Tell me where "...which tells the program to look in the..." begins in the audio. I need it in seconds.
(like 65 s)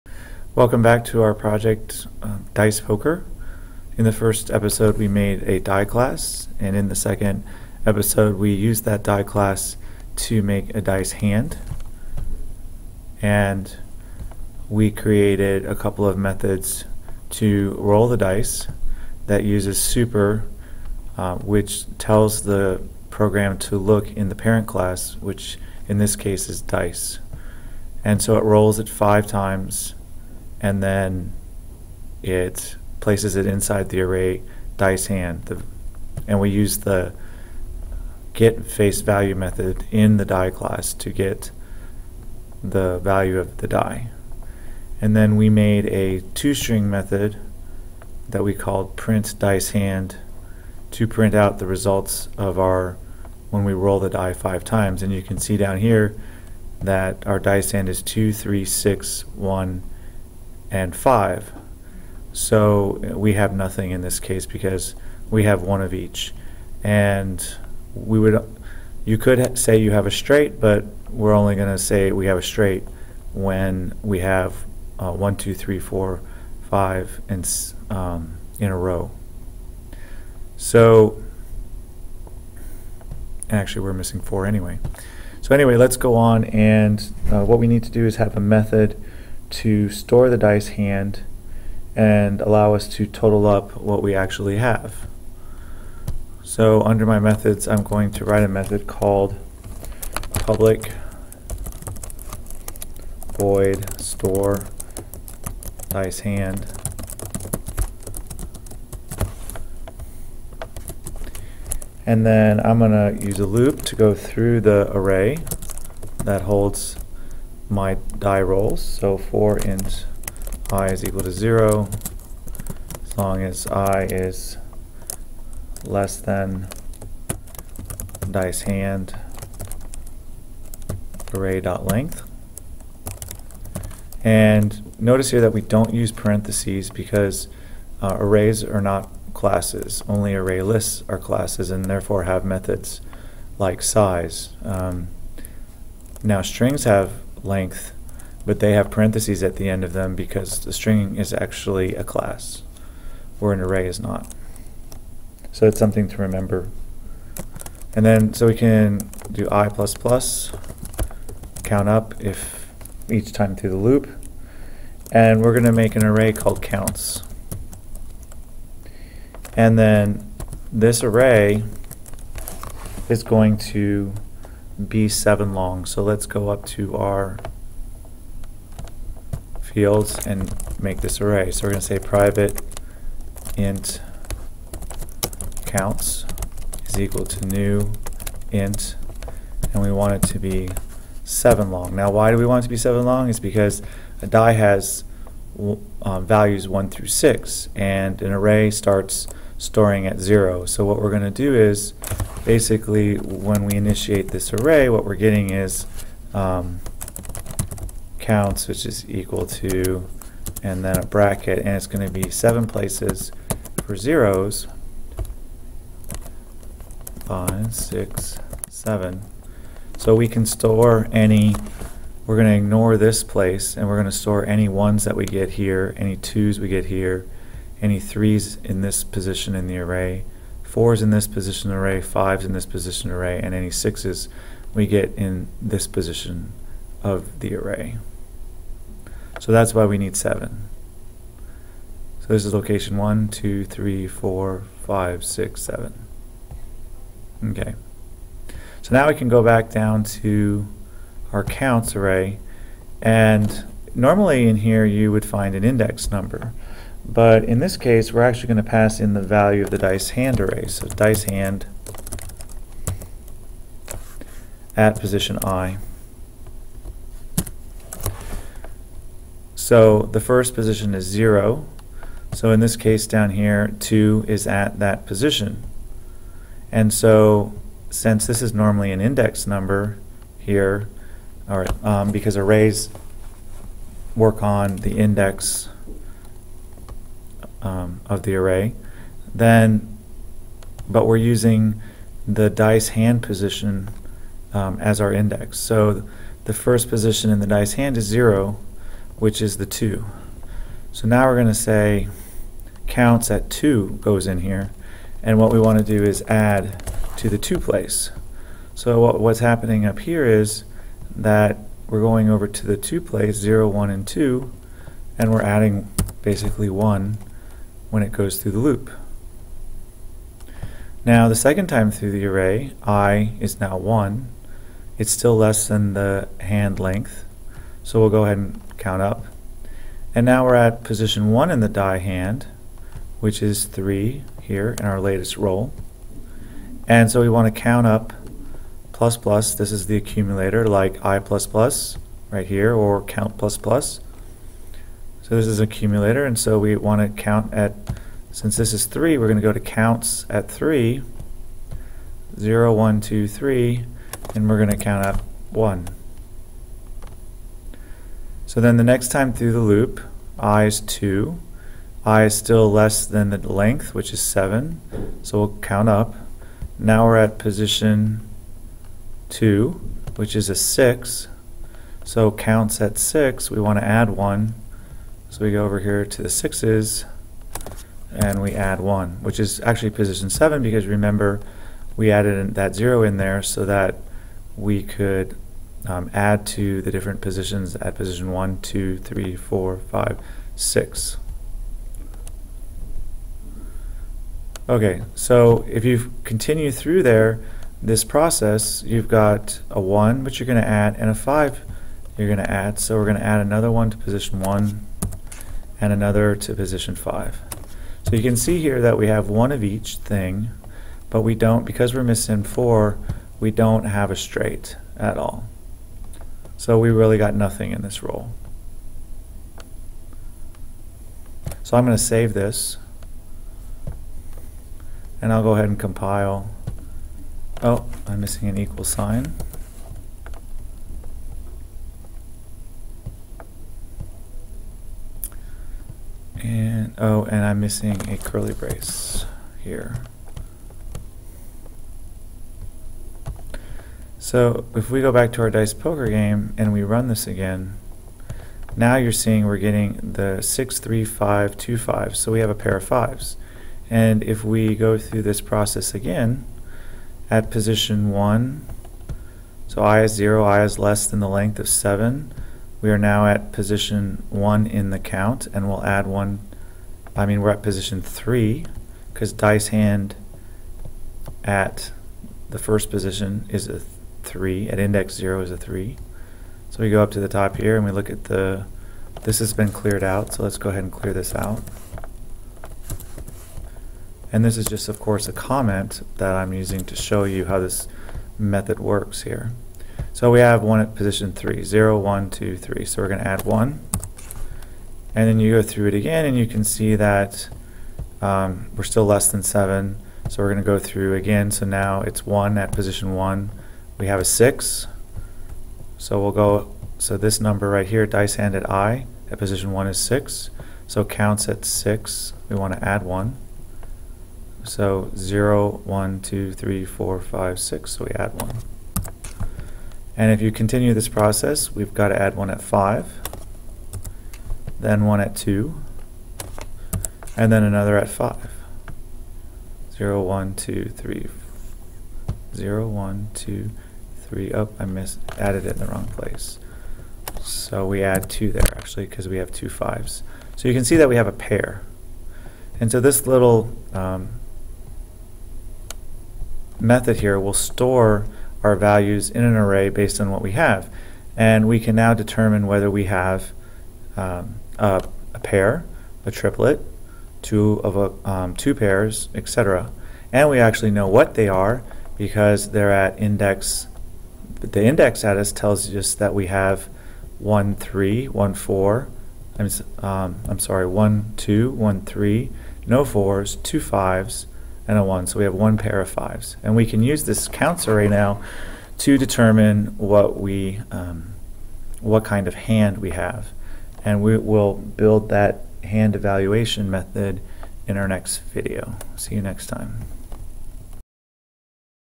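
21 s.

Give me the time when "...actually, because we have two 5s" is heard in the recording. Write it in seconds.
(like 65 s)
538 s.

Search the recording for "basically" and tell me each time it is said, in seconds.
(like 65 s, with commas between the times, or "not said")
202 s, 316 s.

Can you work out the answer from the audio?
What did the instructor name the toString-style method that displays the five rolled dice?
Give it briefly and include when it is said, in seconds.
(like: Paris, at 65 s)
print dice hand, at 48 s.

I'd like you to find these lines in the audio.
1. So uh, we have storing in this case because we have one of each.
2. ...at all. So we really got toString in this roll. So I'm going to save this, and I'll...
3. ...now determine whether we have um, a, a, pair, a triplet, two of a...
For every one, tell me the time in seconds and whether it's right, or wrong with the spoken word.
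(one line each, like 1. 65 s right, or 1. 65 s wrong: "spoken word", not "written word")
1. 62 s wrong: "nothing", not "storing"
2. 414 s wrong: "nothing", not "toString"
3. 551 s right.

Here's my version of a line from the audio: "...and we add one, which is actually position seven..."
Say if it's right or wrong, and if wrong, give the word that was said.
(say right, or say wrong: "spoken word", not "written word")
right.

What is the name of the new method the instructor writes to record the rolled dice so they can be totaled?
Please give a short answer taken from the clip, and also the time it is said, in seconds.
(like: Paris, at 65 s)
store dice hand, at 103 s.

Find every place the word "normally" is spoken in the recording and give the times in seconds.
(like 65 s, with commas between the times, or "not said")
253 s, 278 s.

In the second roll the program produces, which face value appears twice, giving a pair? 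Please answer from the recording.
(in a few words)
5.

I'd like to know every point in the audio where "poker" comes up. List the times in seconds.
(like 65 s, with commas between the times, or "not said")
2 s, 445 s.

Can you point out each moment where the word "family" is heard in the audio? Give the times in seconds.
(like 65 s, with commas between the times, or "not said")
not said.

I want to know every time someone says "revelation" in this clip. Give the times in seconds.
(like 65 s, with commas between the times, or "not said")
not said.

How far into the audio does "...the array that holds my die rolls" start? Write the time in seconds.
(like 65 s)
114 s.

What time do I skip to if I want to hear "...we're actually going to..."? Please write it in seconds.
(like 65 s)
258 s.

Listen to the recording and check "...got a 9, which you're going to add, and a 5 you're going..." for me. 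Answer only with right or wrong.
wrong.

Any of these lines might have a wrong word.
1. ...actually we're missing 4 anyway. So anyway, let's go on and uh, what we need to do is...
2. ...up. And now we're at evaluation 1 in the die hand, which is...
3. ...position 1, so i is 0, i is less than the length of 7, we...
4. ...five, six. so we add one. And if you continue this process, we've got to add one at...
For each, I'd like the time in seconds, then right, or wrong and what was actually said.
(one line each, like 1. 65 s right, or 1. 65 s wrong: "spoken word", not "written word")
1. 83 s right
2. 329 s wrong: "position", not "evaluation"
3. 457 s right
4. 517 s right.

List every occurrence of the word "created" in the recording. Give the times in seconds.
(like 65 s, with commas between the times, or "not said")
14 s.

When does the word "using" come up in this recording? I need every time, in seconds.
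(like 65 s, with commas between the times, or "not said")
291 s, 486 s.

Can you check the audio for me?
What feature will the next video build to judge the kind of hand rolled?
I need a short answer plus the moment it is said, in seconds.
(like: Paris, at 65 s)
hand evaluation method, at 585 s.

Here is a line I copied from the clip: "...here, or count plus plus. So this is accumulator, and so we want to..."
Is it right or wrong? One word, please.
right.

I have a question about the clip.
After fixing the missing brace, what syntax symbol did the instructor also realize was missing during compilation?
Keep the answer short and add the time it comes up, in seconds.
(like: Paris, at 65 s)
equal sign, at 428 s.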